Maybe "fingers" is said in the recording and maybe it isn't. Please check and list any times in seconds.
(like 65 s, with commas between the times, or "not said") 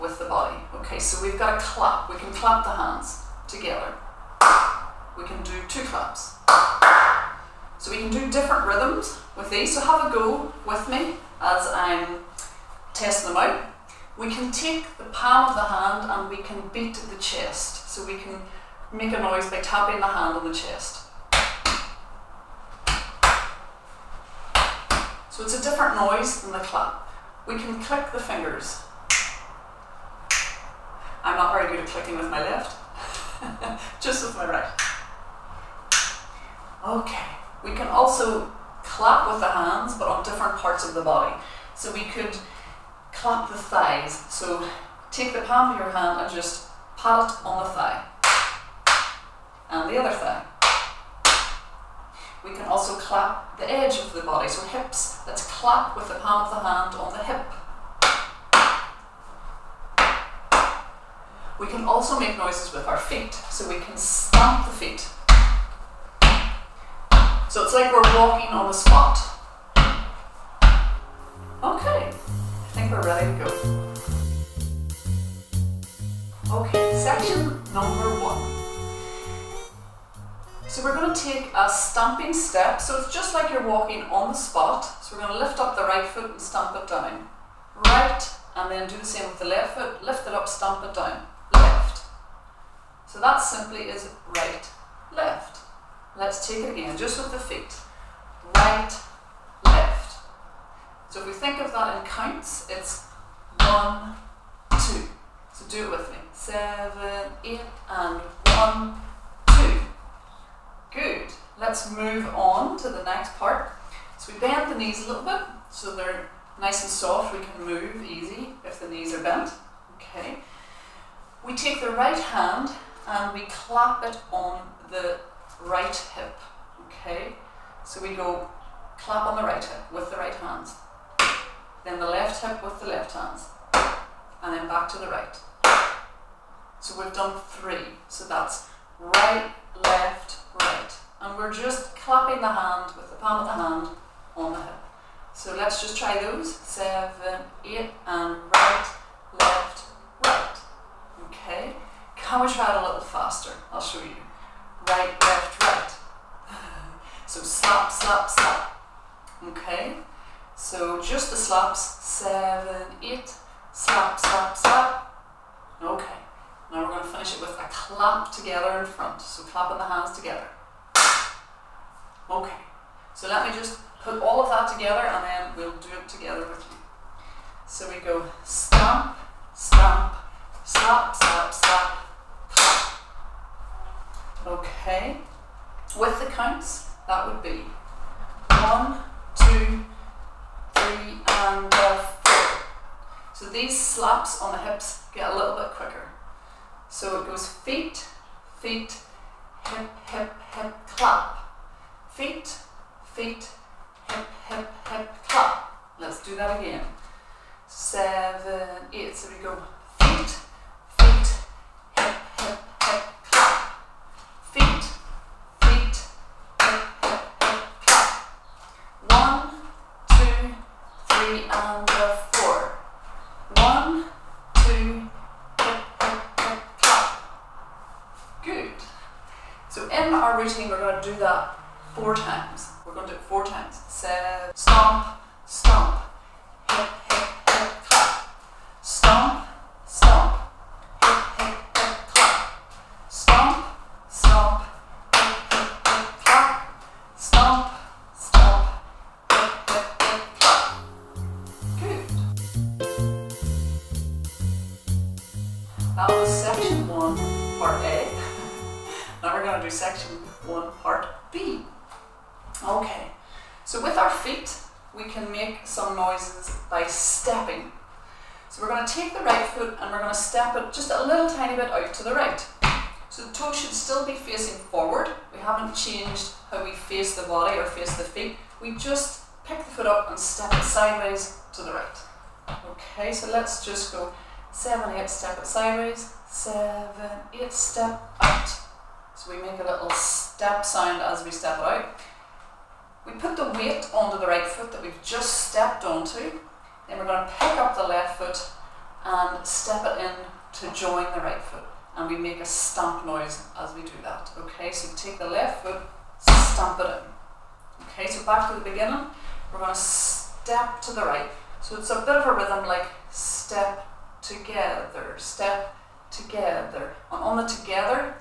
28 s.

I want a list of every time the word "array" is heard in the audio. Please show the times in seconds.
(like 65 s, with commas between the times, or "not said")
not said.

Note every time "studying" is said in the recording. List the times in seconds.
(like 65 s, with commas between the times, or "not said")
not said.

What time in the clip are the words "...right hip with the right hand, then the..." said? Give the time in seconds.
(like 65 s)
129 s.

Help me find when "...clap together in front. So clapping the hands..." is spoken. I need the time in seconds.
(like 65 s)
167 s.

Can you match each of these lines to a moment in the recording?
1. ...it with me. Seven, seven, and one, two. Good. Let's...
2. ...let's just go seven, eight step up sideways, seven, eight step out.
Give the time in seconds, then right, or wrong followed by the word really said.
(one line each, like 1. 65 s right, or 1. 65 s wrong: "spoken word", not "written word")
1. 105 s wrong: "eight", not "seven"
2. 283 s right.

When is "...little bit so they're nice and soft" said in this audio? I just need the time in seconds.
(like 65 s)
115 s.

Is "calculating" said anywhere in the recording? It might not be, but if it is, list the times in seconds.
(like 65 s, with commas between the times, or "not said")
not said.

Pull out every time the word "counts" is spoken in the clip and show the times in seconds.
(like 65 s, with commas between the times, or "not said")
102 s, 186 s.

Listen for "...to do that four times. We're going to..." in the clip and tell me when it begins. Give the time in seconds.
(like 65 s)
231 s.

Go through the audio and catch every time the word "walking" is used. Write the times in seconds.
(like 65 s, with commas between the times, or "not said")
68 s, 83 s.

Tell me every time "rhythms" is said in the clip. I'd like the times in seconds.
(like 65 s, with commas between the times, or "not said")
8 s, 312 s.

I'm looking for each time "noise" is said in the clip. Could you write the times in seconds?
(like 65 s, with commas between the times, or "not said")
19 s, 25 s, 62 s, 303 s.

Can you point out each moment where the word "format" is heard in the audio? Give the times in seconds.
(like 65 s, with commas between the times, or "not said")
not said.